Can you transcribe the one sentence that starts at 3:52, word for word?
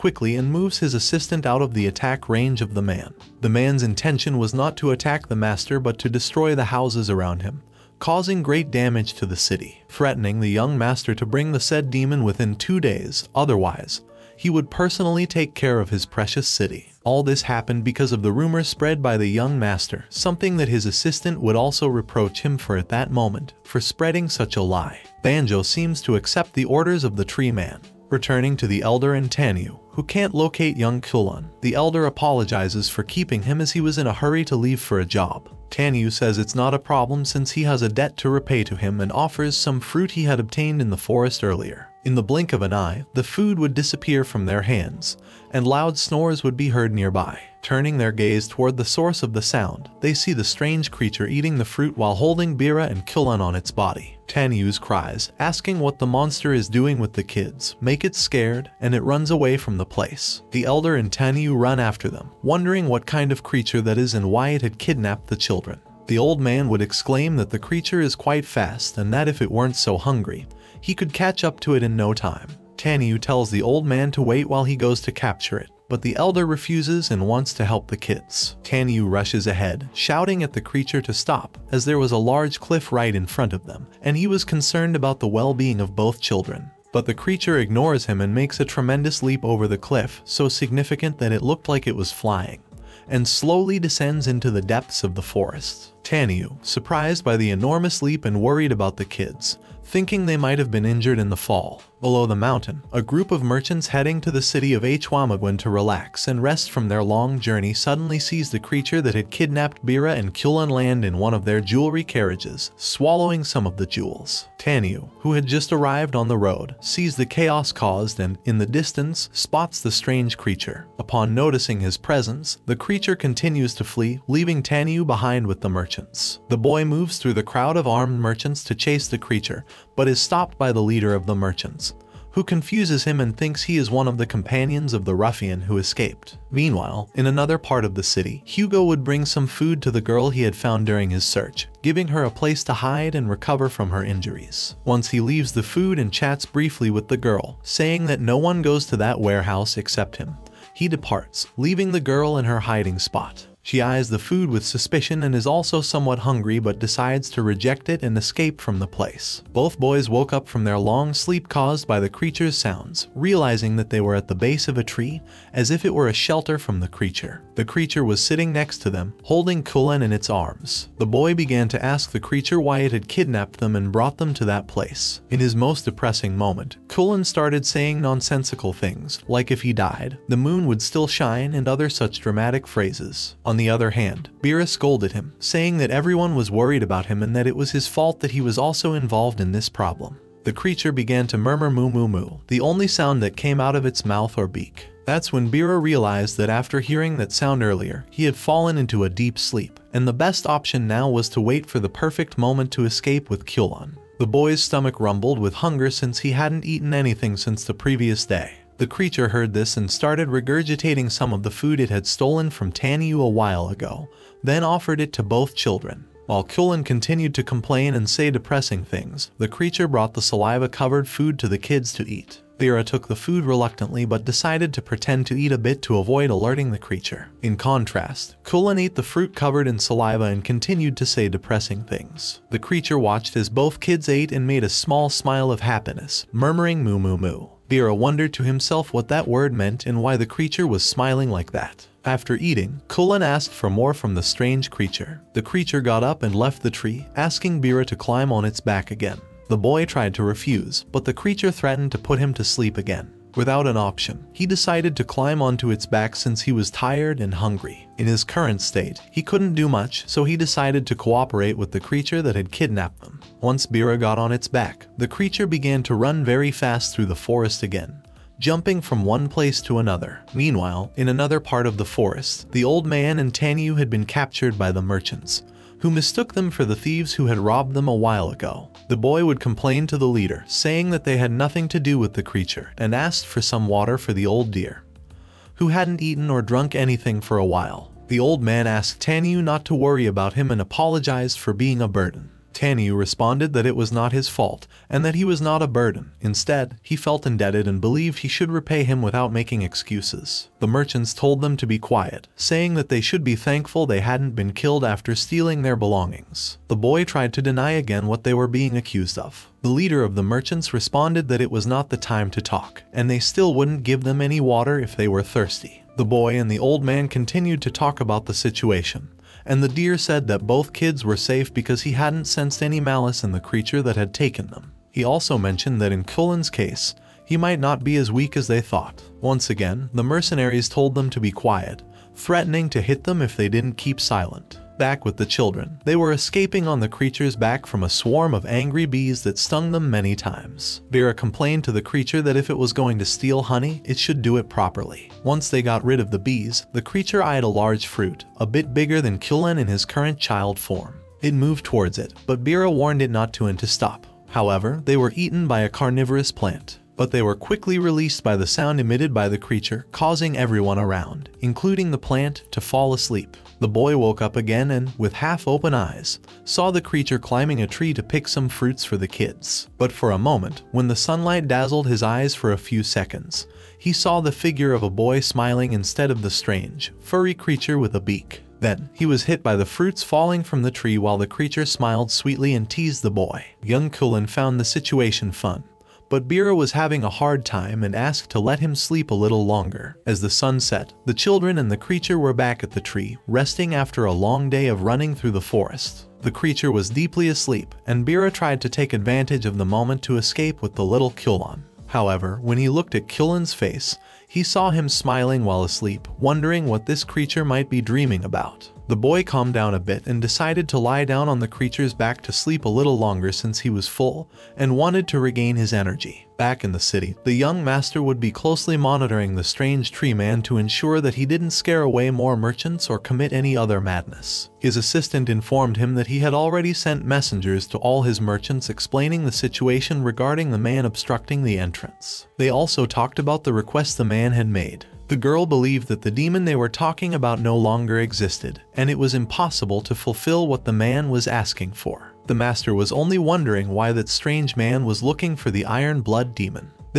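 The creature watched as both kids ate and made a small smile of happiness, murmuring moo moo moo.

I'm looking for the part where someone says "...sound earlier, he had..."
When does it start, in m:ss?
3:17.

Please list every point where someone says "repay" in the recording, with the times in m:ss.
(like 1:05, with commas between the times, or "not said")
0:38, 4:58.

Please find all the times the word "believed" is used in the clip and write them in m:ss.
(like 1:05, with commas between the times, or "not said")
4:57, 7:15.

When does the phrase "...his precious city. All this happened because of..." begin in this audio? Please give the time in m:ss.
0:15.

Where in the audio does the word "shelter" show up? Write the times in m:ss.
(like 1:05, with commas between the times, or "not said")
2:46.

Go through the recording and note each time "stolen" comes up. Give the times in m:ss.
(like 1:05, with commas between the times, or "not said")
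3:32.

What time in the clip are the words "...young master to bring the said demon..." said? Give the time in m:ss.
0:10.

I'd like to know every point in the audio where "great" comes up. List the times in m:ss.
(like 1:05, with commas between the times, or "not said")
0:08.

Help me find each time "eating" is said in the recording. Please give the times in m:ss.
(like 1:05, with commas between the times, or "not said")
0:51, 4:02.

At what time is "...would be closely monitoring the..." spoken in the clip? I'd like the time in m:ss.
6:58.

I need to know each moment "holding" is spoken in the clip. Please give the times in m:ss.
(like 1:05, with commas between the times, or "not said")
0:52, 2:49.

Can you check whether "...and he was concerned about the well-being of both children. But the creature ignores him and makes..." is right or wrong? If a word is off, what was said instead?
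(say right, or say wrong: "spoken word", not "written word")
right.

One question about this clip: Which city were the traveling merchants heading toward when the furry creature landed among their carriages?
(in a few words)
Hwamagwen.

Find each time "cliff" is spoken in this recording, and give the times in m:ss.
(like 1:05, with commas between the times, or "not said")
1:22, 1:29.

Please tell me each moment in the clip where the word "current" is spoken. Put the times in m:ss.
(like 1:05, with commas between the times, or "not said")
4:18, 5:49.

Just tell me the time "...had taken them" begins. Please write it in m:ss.
5:23.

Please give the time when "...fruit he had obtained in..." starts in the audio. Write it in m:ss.
0:39.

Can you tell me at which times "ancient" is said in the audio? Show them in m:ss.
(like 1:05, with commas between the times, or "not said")
not said.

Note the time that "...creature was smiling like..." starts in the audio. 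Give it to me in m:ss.
4:00.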